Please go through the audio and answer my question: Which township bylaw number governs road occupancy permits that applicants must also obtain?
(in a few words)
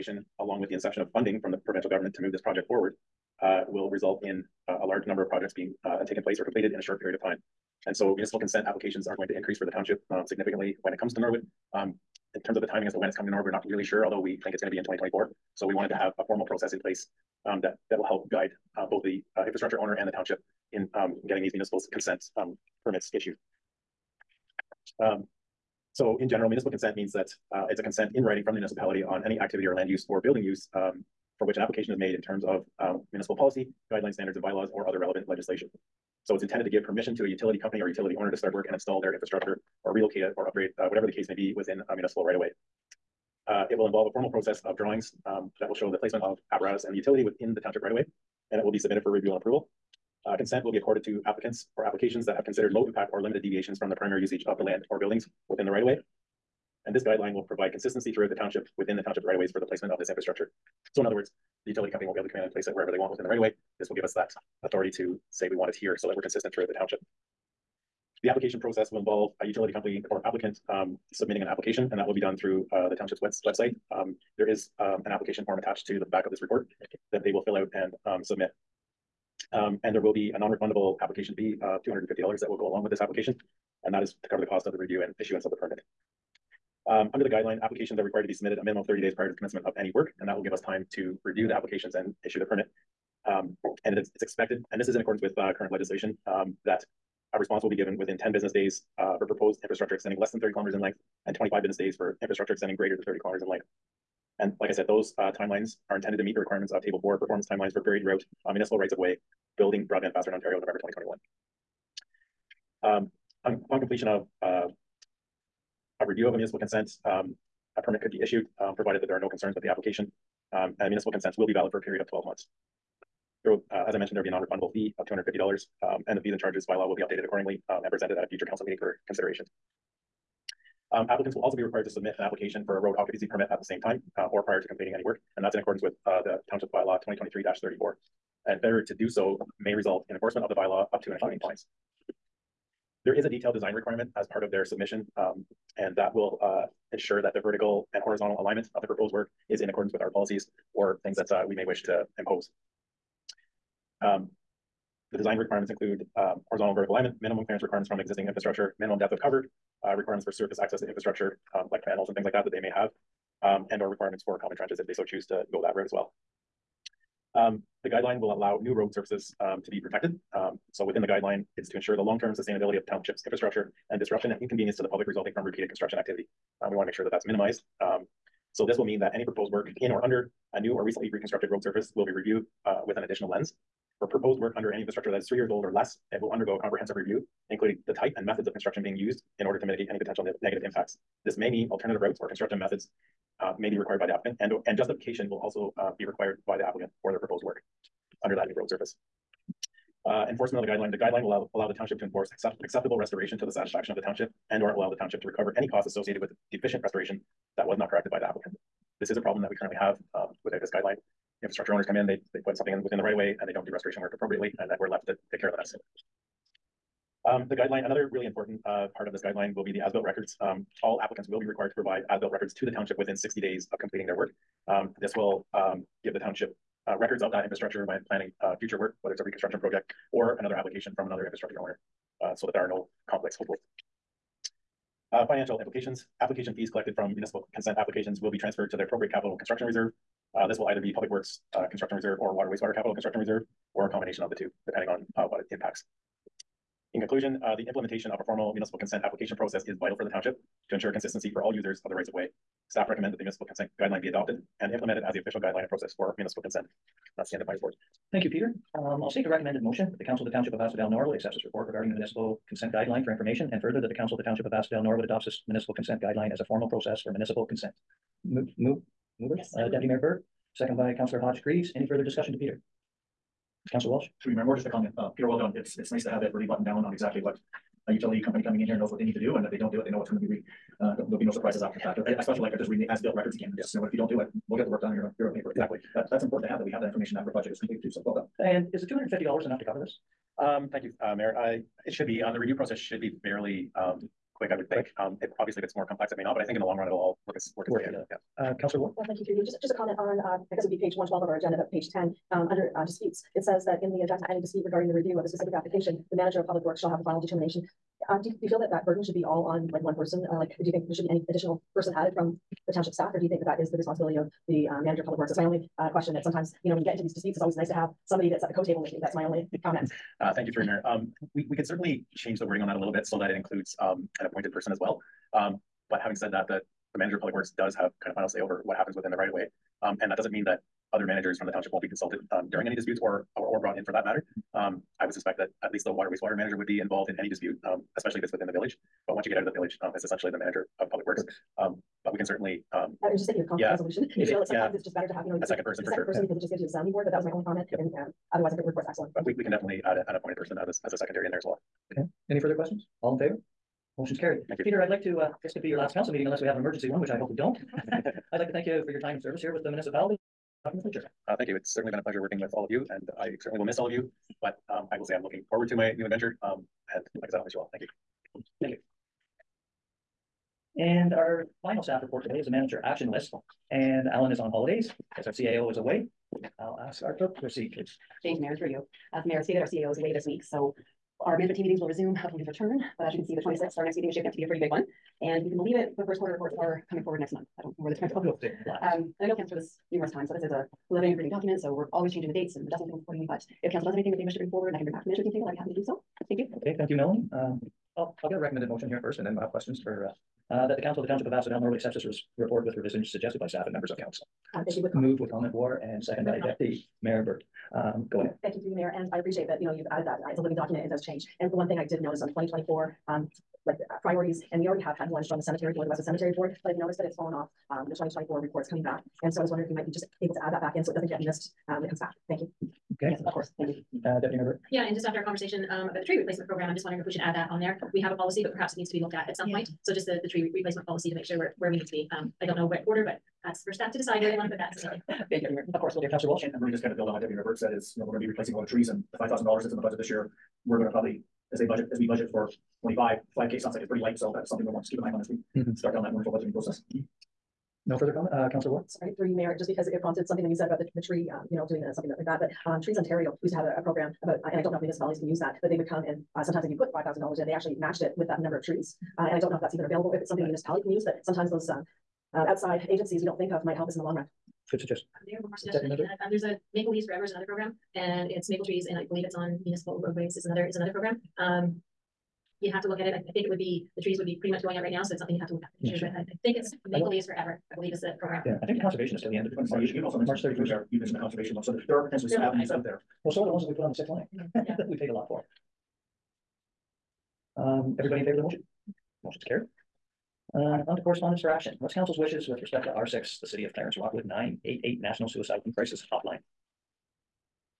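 2023-34.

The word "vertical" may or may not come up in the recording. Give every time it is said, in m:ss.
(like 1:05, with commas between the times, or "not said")
2:27, 2:36.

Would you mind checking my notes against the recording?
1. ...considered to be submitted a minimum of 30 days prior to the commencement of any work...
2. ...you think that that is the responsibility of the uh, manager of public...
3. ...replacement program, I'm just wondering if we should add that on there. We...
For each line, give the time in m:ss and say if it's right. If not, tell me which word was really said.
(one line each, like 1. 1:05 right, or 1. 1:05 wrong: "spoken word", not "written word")
1. 1:28 wrong: "required", not "considered"
2. 5:13 right
3. 7:06 right.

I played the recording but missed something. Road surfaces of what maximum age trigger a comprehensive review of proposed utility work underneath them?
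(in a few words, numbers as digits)
3 years.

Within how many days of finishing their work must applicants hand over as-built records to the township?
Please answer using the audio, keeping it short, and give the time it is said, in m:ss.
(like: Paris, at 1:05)
60 days, at 3:43.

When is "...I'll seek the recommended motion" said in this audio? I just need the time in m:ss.
4:19.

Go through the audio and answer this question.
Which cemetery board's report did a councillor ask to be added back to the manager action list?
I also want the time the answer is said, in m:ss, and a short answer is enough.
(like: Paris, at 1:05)
Westwood Cemetery Board, at 6:55.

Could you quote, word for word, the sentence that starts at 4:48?
And is the two hundred and fifty dollars enough to cover this?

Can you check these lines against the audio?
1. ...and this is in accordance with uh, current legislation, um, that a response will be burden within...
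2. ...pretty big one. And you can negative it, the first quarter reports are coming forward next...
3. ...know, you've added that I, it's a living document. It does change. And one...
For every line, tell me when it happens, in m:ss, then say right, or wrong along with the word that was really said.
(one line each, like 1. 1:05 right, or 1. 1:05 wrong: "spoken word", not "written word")
1. 1:34 wrong: "given", not "burden"
2. 6:24 wrong: "believe", not "negative"
3. 6:49 right.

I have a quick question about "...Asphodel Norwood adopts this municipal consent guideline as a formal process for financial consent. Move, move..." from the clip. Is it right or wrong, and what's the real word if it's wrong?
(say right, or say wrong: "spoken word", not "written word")
wrong: "municipal", not "financial".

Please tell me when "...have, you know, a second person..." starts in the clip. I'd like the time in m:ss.
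5:45.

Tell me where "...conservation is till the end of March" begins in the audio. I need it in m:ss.
7:58.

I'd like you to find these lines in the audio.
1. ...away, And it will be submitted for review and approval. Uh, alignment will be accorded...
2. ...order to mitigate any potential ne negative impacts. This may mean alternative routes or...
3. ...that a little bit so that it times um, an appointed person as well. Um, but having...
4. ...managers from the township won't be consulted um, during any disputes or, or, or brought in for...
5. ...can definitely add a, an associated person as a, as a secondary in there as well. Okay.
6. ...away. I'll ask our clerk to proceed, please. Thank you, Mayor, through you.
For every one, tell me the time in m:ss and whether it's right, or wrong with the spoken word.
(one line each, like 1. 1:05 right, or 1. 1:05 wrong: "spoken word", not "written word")
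1. 0:47 wrong: "consent", not "alignment"
2. 3:09 right
3. 5:22 wrong: "includes", not "times"
4. 5:31 right
5. 5:49 wrong: "appointed", not "associated"
6. 6:15 right.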